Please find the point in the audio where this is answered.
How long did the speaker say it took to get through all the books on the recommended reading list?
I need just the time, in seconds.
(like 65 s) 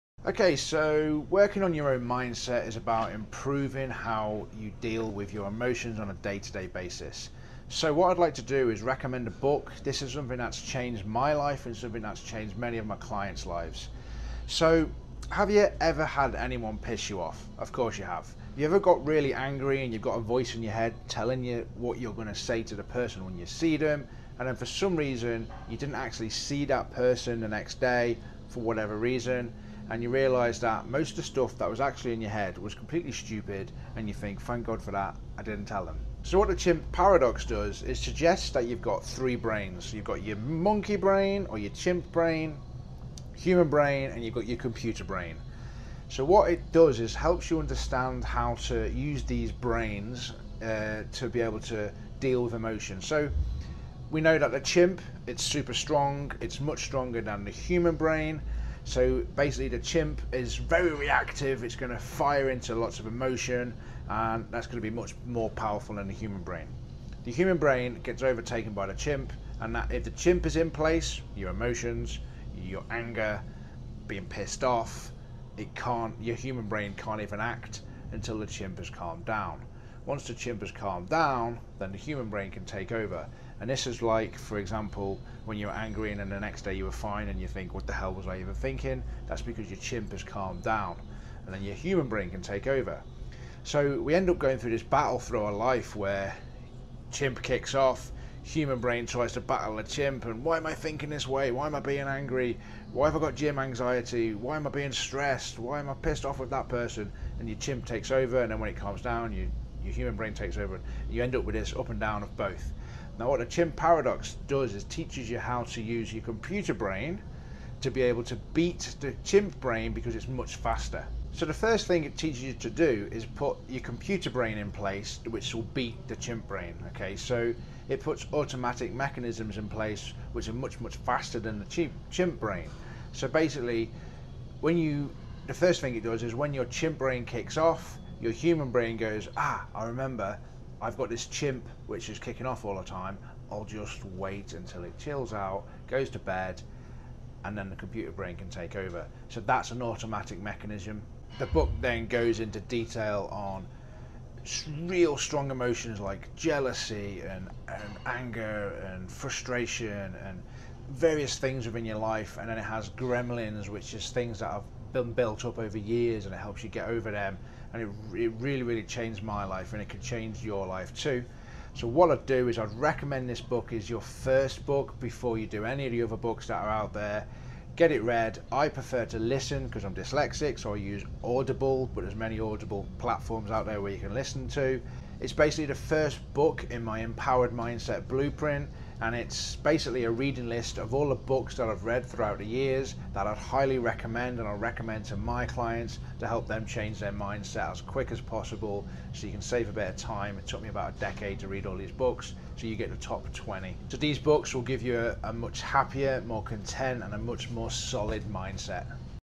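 200 s.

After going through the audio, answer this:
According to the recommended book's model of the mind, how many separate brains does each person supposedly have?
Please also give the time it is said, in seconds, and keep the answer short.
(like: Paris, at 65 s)
3, at 39 s.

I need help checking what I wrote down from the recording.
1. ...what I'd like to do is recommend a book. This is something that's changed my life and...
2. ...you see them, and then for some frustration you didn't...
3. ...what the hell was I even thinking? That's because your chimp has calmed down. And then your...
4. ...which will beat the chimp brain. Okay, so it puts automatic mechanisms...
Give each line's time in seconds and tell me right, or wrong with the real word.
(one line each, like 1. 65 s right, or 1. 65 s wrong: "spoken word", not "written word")
1. 7 s right
2. 23 s wrong: "reason", not "frustration"
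3. 87 s right
4. 125 s right.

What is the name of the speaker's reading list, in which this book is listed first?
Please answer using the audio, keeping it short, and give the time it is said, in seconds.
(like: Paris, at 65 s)
Empowered Mindset Blueprint, at 186 s.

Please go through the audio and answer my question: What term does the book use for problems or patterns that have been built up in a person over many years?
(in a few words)
gremlins.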